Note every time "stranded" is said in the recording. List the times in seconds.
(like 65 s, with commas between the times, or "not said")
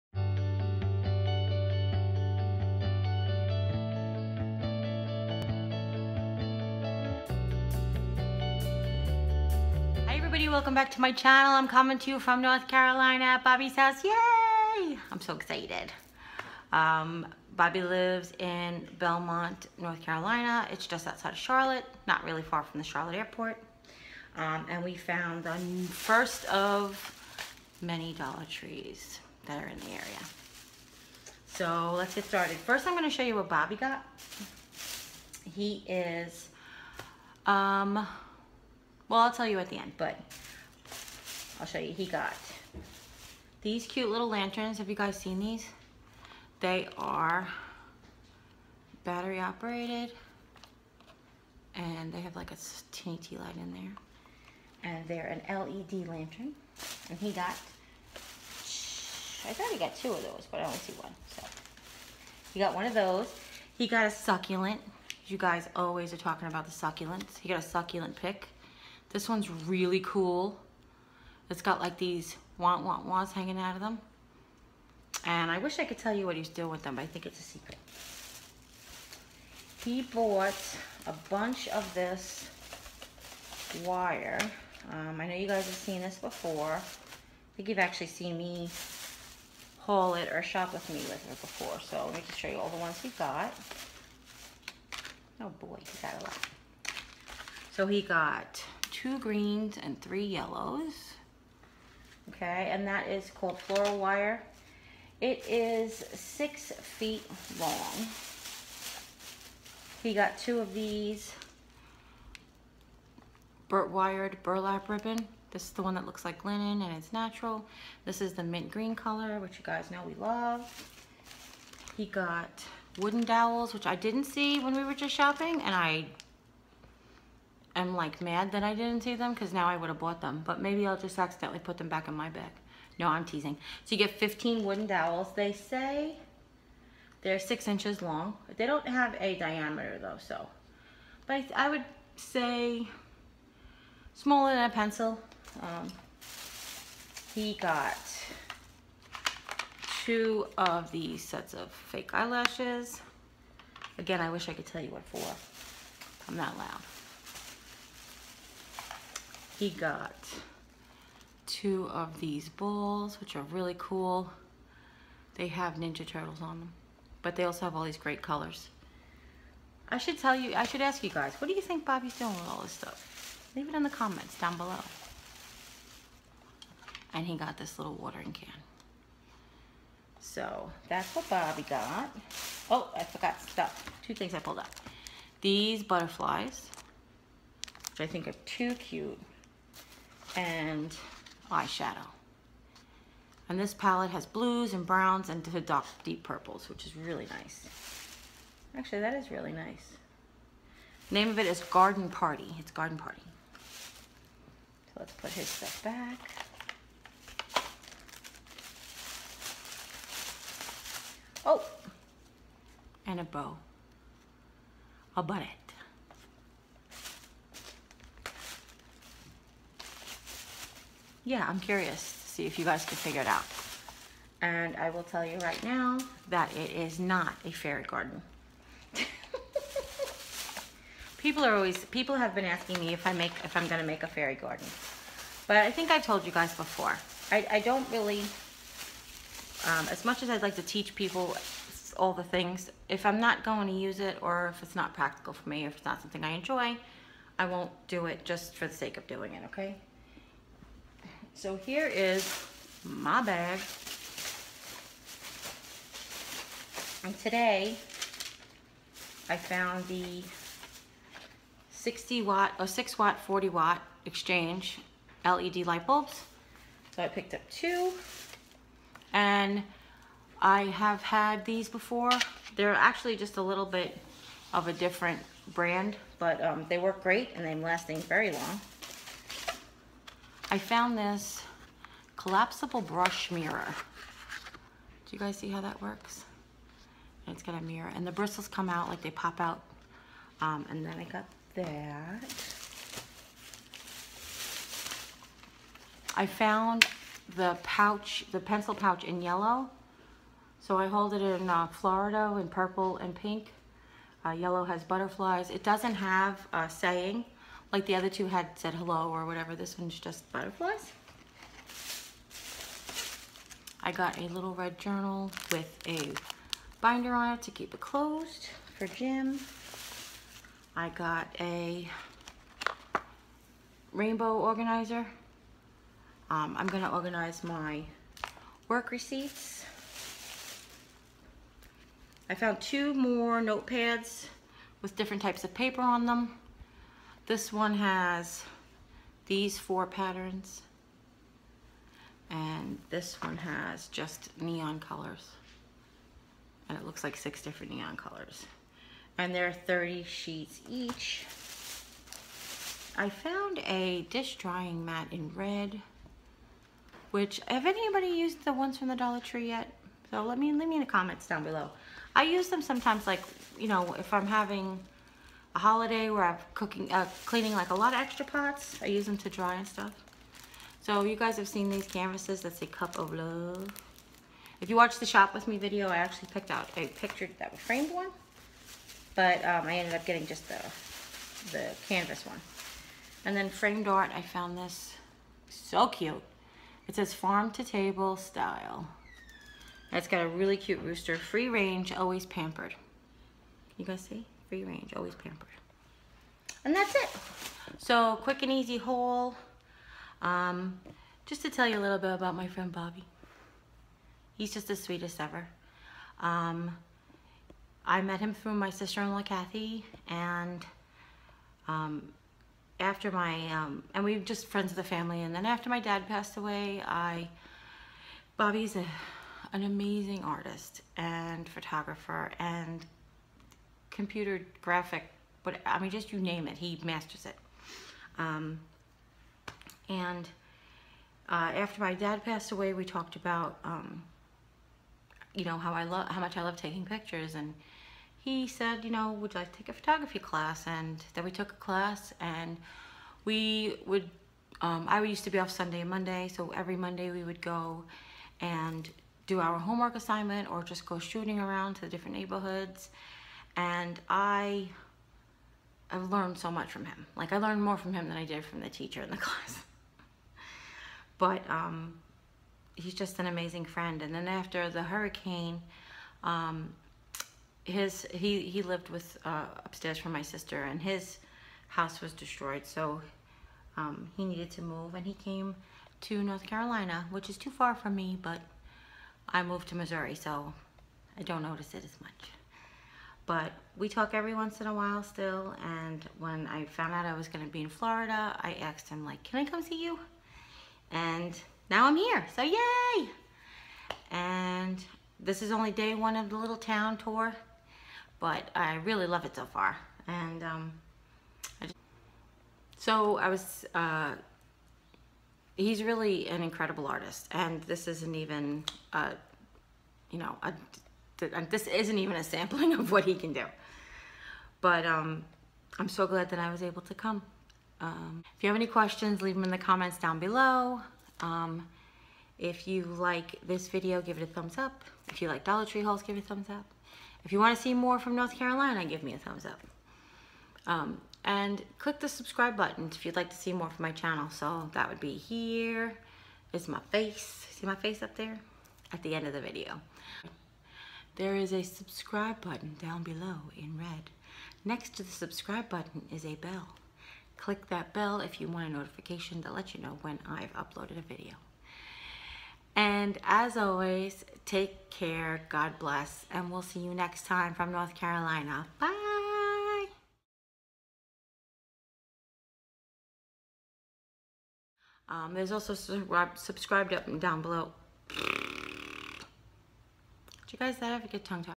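not said.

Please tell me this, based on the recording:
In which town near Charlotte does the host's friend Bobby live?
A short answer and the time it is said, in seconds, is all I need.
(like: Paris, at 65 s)
Belmont, at 18 s.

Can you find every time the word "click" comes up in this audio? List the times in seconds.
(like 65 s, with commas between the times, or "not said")
531 s, 547 s.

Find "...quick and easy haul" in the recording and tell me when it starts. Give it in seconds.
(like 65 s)
398 s.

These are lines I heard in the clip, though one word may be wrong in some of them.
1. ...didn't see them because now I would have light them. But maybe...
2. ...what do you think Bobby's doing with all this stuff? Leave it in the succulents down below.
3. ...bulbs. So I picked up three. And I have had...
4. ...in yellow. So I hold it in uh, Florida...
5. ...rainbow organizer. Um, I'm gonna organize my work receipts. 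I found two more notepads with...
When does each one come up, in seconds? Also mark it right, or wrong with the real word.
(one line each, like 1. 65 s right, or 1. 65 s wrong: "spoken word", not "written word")
1. 128 s wrong: "bought", not "light"
2. 171 s wrong: "comments", not "succulents"
3. 265 s wrong: "two", not "three"
4. 299 s right
5. 323 s right.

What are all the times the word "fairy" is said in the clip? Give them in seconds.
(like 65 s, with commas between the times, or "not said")
227 s, 234 s.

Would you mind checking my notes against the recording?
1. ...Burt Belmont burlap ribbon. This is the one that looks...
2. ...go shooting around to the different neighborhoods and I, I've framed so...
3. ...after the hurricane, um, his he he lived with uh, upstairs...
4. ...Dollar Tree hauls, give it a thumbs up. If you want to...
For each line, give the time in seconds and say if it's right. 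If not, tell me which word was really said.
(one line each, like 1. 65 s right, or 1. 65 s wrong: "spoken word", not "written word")
1. 113 s wrong: "Wired", not "Belmont"
2. 450 s wrong: "learned", not "framed"
3. 464 s right
4. 525 s right.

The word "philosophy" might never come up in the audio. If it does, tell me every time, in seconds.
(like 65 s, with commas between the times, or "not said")
not said.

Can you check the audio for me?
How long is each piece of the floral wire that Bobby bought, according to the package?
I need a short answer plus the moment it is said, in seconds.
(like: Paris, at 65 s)
6 feet, at 106 s.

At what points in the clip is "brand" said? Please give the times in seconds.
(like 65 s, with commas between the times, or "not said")
275 s.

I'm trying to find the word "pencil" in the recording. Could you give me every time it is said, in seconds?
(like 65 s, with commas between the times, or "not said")
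144 s, 298 s.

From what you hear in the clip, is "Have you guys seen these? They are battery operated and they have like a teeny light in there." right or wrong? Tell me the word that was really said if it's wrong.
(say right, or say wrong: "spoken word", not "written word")
right.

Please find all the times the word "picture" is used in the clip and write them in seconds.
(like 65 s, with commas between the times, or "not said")
376 s, 436 s.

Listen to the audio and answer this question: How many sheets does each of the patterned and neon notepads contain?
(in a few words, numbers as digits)
30.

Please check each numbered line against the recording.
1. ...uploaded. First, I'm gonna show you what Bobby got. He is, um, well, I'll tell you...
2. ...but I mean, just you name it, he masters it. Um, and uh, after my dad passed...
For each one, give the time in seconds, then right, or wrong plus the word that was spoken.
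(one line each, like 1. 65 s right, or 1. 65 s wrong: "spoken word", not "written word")
1. 32 s wrong: "started", not "uploaded"
2. 425 s right.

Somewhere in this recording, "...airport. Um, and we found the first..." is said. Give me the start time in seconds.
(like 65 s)
23 s.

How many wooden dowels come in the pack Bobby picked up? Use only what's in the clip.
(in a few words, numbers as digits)
15.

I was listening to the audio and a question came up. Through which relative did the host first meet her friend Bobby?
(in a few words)
Sister-in-law Kathy.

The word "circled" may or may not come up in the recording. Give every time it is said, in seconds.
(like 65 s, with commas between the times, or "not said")
not said.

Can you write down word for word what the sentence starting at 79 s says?
He bought a bunch of this wire.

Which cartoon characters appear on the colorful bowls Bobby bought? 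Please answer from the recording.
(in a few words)
Ninja Turtles.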